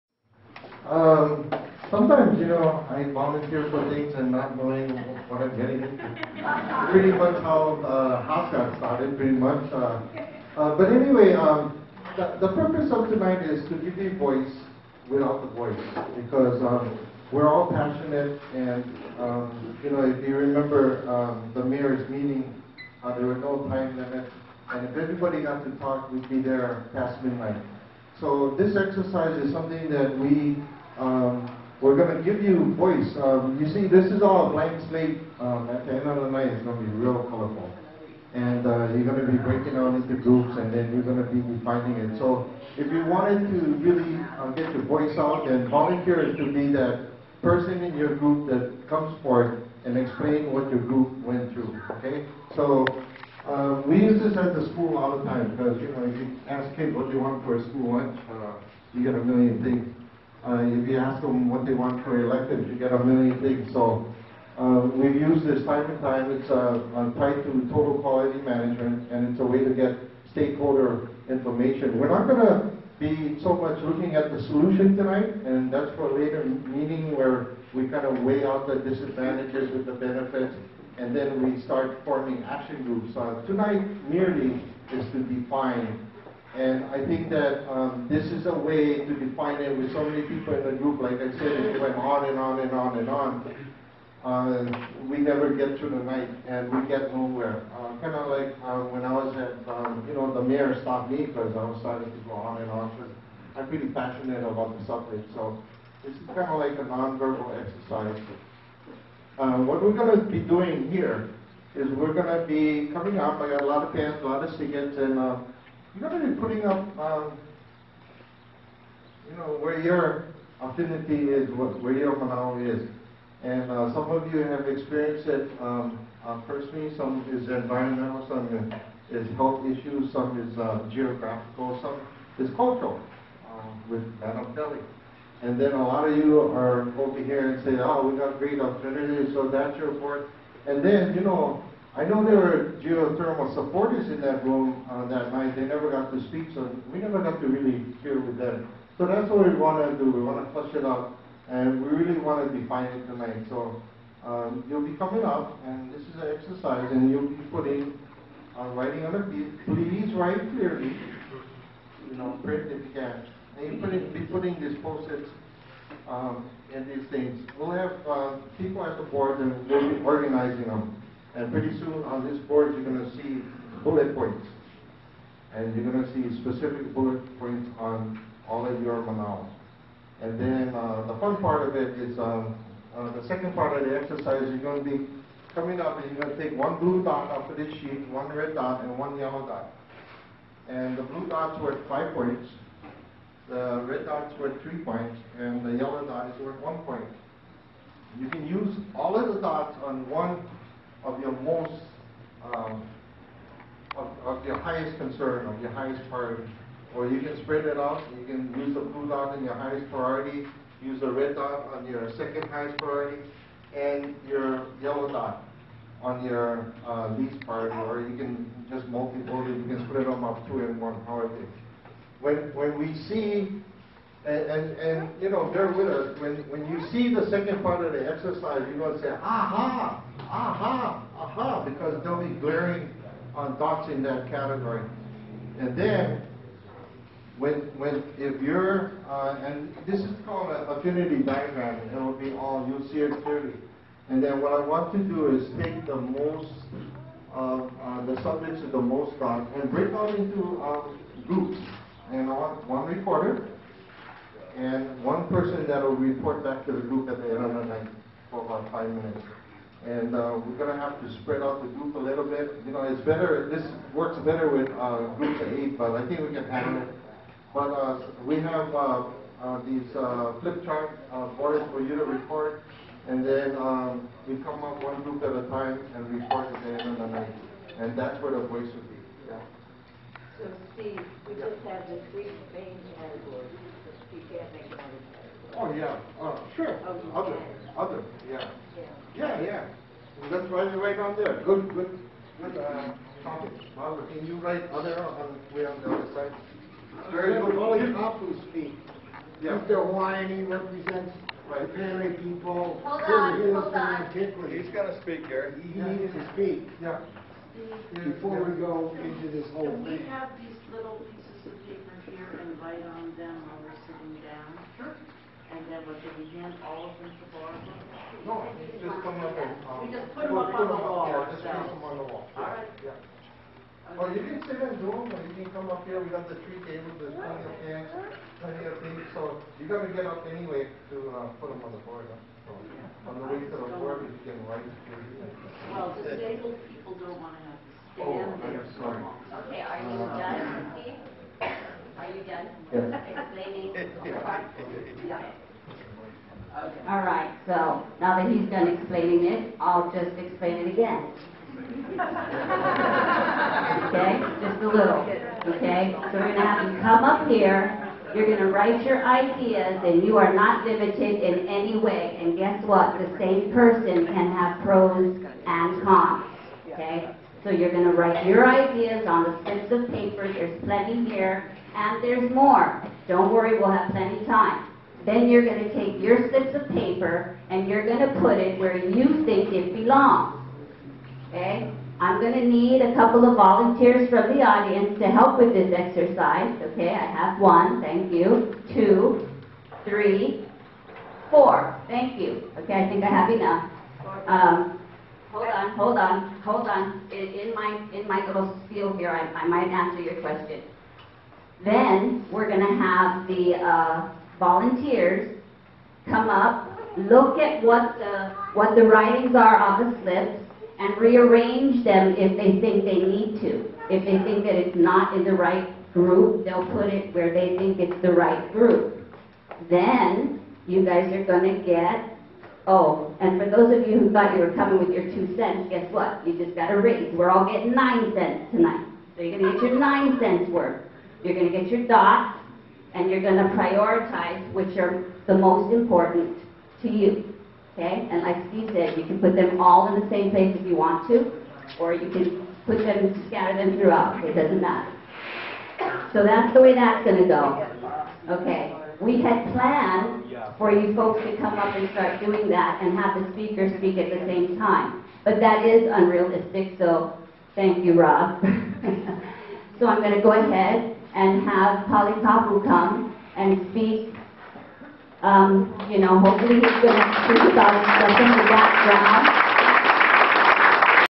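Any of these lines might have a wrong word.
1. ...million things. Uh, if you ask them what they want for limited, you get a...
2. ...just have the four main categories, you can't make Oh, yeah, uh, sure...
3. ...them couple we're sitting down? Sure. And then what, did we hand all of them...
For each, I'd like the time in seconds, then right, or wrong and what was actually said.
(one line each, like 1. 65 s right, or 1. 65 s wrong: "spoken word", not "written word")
1. 59 s wrong: "elected", not "limited"
2. 281 s wrong: "three", not "four"
3. 313 s wrong: "while", not "couple".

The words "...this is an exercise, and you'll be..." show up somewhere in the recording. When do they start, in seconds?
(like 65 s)
155 s.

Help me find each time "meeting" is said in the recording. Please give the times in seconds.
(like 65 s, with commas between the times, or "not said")
22 s, 76 s.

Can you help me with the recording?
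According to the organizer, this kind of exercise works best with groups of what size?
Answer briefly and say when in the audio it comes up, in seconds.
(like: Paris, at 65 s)
8, at 265 s.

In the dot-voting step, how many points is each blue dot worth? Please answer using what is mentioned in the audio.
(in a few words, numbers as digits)
5.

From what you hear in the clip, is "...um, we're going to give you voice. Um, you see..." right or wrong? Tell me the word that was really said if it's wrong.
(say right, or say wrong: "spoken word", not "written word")
right.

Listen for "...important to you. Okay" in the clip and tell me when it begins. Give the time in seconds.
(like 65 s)
435 s.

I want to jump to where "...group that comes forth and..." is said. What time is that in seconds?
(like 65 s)
48 s.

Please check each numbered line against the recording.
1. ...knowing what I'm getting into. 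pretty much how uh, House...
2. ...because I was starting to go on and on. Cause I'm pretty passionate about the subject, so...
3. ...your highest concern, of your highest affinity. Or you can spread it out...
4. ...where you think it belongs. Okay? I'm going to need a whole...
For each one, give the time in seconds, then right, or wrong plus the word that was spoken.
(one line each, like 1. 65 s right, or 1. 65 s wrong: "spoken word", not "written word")
1. 4 s right
2. 101 s right
3. 204 s wrong: "priority", not "affinity"
4. 378 s wrong: "couple", not "whole".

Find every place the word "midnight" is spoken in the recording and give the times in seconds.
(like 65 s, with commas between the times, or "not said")
27 s.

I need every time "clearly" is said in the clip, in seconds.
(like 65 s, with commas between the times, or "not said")
160 s, 243 s.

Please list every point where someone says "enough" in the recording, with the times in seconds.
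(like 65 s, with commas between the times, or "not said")
393 s.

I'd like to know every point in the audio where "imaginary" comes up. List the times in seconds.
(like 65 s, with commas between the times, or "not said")
not said.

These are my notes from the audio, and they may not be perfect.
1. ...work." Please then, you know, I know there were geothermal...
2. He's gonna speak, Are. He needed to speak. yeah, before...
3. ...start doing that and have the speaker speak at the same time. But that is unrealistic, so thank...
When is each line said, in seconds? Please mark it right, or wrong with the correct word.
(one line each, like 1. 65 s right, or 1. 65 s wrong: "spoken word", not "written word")
1. 139 s wrong: "And", not "Please"
2. 304 s wrong: "Gary", not "Are"
3. 451 s right.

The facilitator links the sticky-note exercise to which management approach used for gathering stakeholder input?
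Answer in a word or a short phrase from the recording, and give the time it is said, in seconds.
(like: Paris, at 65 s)
total quality management, at 67 s.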